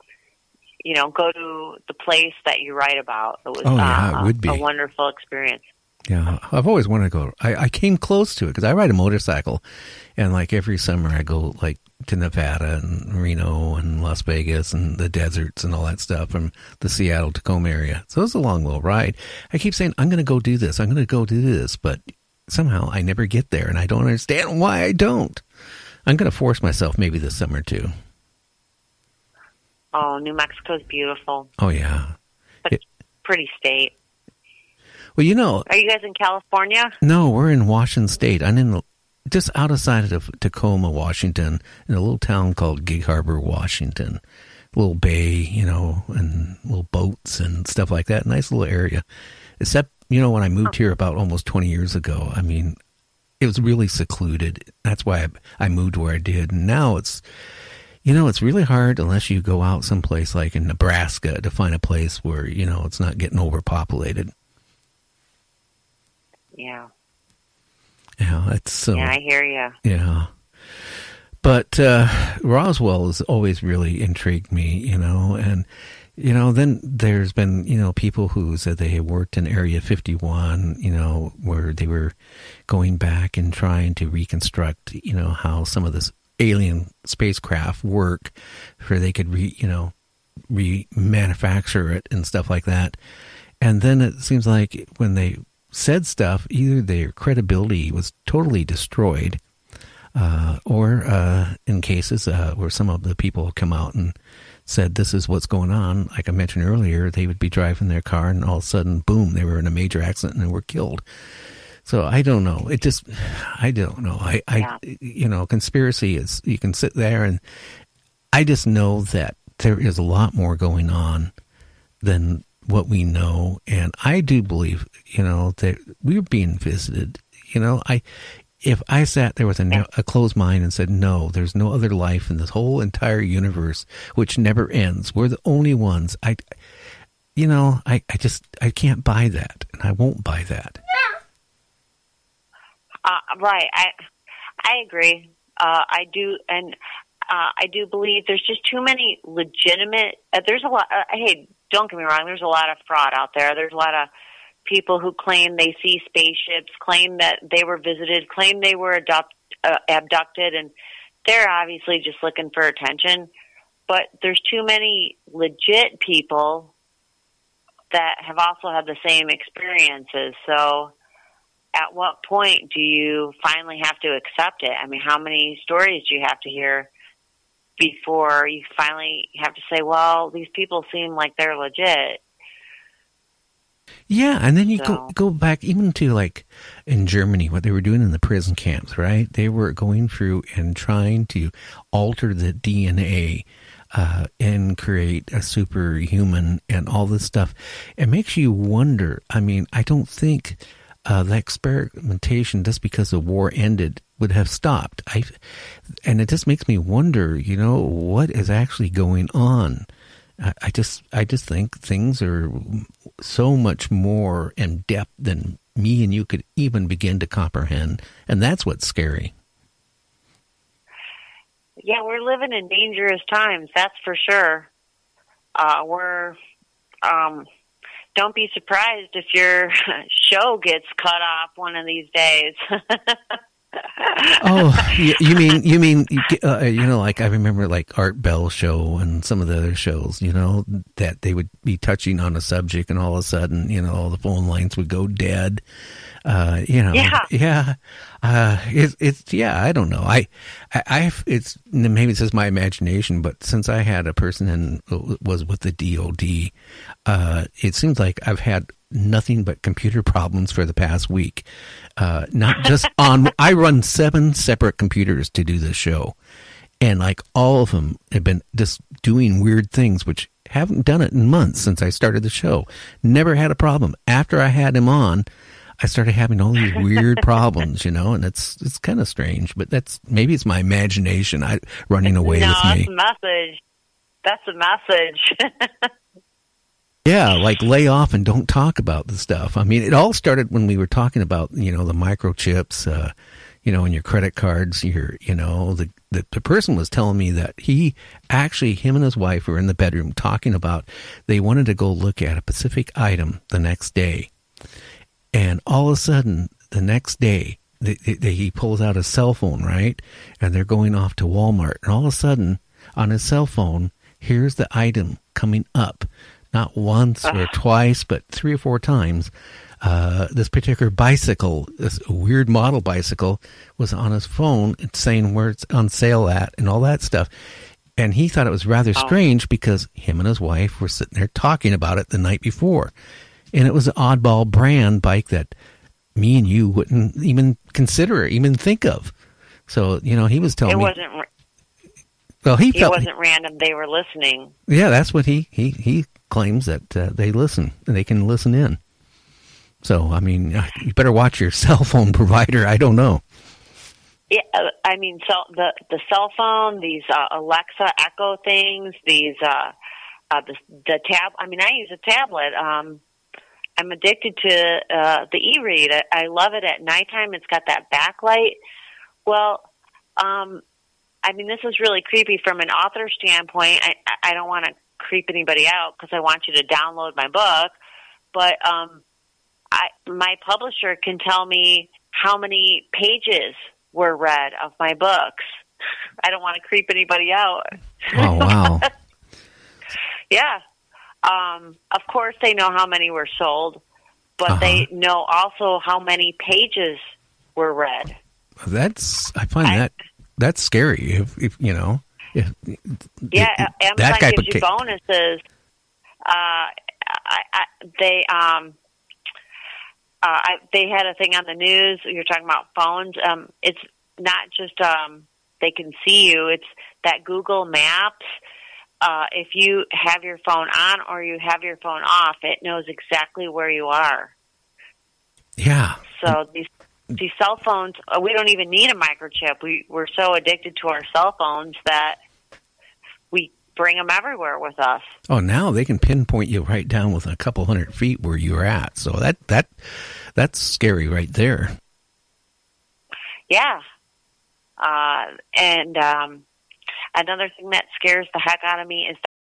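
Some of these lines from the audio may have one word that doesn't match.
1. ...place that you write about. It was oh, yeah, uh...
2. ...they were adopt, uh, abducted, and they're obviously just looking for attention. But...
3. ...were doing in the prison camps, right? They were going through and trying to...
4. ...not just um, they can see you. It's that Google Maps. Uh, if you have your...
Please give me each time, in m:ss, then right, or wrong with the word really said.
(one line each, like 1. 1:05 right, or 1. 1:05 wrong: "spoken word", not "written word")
1. 0:01 right
2. 2:38 right
3. 3:07 right
4. 6:54 right.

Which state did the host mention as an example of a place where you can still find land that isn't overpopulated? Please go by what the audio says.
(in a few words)
Nebraska.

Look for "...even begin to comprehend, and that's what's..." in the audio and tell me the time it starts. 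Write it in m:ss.
3:36.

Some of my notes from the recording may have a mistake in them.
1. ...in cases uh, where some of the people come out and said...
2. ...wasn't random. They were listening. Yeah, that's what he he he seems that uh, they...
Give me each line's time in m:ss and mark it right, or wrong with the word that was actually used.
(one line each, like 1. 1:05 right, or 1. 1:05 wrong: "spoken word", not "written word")
1. 1:41 right
2. 5:42 wrong: "claims", not "seems".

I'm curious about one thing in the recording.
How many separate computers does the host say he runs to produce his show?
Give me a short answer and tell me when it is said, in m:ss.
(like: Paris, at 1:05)
7, at 4:23.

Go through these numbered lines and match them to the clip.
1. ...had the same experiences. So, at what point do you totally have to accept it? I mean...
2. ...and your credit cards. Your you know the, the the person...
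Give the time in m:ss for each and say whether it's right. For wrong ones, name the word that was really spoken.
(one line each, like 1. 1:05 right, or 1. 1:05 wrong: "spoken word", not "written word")
1. 2:48 wrong: "finally", not "totally"
2. 4:53 right.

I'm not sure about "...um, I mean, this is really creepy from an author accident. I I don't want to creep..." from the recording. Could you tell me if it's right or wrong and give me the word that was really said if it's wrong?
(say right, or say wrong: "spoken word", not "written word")
wrong: "standpoint", not "accident".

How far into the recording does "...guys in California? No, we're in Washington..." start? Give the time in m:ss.
0:35.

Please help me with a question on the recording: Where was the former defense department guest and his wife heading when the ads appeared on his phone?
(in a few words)
Walmart.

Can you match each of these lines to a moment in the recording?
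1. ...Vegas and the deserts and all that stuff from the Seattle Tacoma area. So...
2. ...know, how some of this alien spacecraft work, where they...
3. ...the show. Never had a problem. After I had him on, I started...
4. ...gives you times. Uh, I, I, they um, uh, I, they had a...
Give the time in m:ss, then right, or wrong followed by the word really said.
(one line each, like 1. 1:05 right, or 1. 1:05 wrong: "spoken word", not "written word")
1. 0:14 right
2. 1:25 right
3. 4:32 right
4. 6:44 wrong: "bonuses", not "times".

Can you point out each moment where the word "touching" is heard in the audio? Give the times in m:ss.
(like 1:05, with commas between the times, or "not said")
4:01.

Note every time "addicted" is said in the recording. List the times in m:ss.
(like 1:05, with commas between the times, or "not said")
6:03, 7:10.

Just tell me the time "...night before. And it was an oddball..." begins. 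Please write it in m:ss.
5:32.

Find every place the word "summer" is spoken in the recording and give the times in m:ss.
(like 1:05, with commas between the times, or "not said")
0:10, 0:27.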